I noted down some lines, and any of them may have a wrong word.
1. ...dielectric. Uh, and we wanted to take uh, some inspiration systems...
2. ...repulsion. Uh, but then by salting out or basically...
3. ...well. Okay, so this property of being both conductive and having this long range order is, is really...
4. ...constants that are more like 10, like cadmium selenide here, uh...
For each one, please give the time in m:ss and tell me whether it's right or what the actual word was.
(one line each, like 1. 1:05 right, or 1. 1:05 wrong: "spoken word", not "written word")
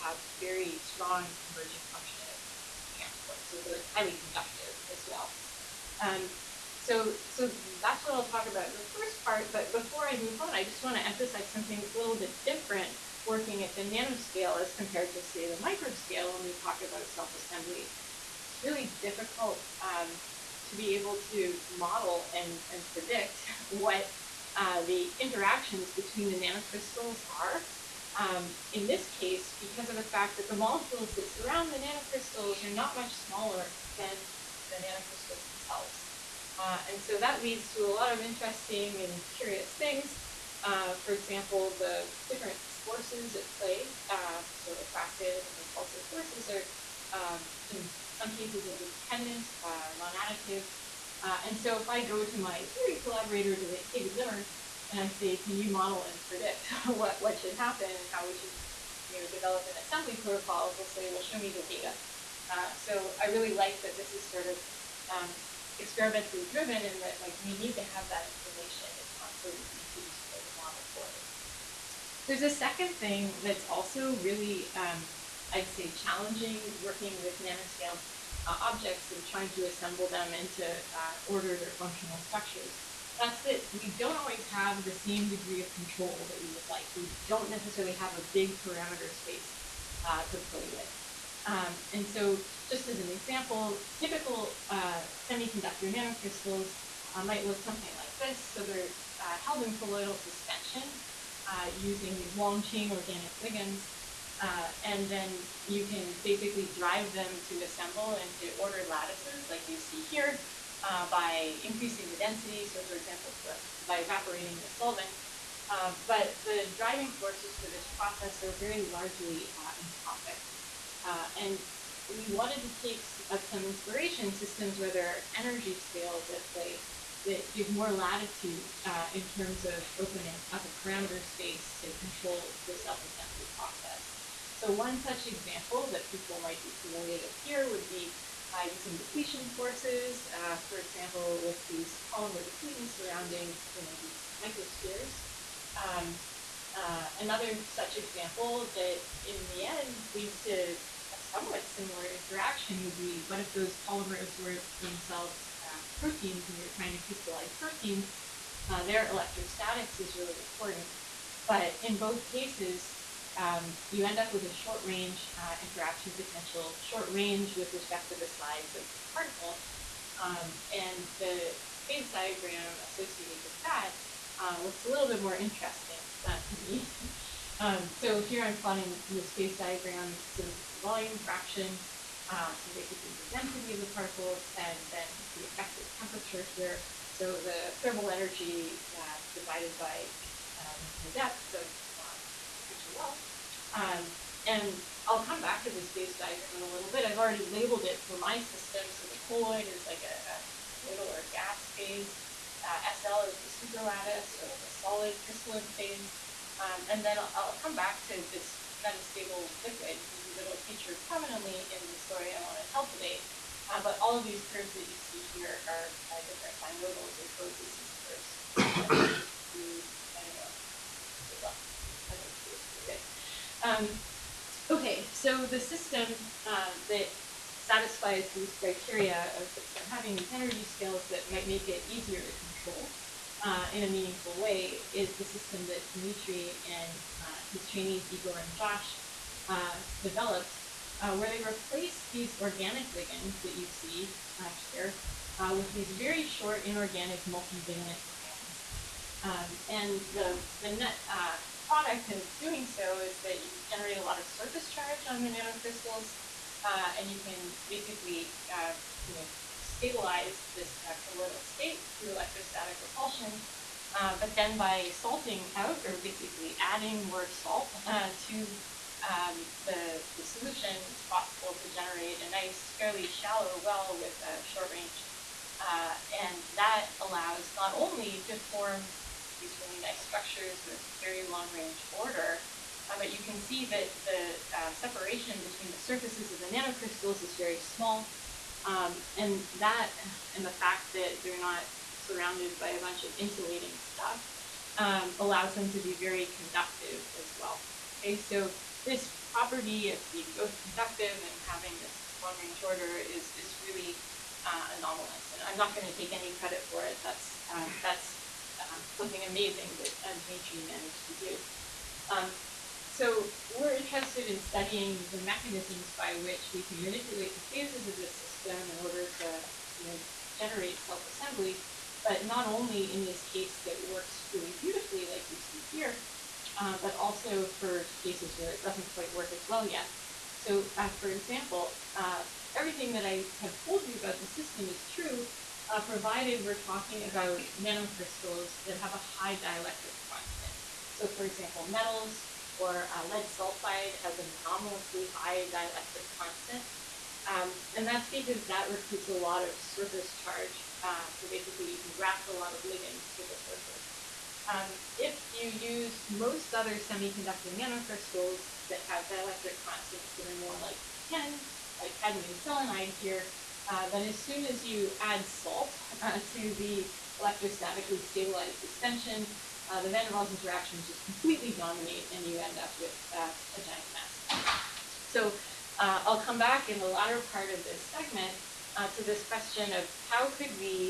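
1. 1:59 wrong: "entropic", not "dielectric"
2. 4:22 right
3. 4:57 right
4. 5:59 right.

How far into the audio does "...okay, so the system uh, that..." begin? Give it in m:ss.
3:44.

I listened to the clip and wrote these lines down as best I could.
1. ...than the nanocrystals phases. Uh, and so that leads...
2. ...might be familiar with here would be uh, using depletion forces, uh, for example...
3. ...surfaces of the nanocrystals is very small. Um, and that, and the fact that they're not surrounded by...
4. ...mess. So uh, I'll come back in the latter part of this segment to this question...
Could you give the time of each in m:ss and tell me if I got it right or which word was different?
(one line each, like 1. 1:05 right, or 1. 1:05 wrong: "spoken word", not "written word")
1. 0:33 wrong: "themselves", not "phases"
2. 2:16 right
3. 4:45 right
4. 6:13 right.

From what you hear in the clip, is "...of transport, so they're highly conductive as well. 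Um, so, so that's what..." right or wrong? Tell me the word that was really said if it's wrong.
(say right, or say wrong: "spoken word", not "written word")
right.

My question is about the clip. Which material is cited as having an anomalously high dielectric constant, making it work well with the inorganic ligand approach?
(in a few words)
Lead sulfide.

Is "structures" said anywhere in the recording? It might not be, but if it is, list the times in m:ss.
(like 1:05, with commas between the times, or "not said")
1:22, 4:40.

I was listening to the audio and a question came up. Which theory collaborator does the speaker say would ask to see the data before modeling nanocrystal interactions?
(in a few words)
David Limmer.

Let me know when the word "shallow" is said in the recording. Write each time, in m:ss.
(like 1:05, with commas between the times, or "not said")
4:33.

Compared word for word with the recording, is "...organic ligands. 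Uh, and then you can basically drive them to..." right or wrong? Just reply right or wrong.
right.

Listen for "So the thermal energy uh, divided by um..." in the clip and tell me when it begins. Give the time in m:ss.
3:07.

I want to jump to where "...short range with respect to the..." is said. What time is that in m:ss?
2:46.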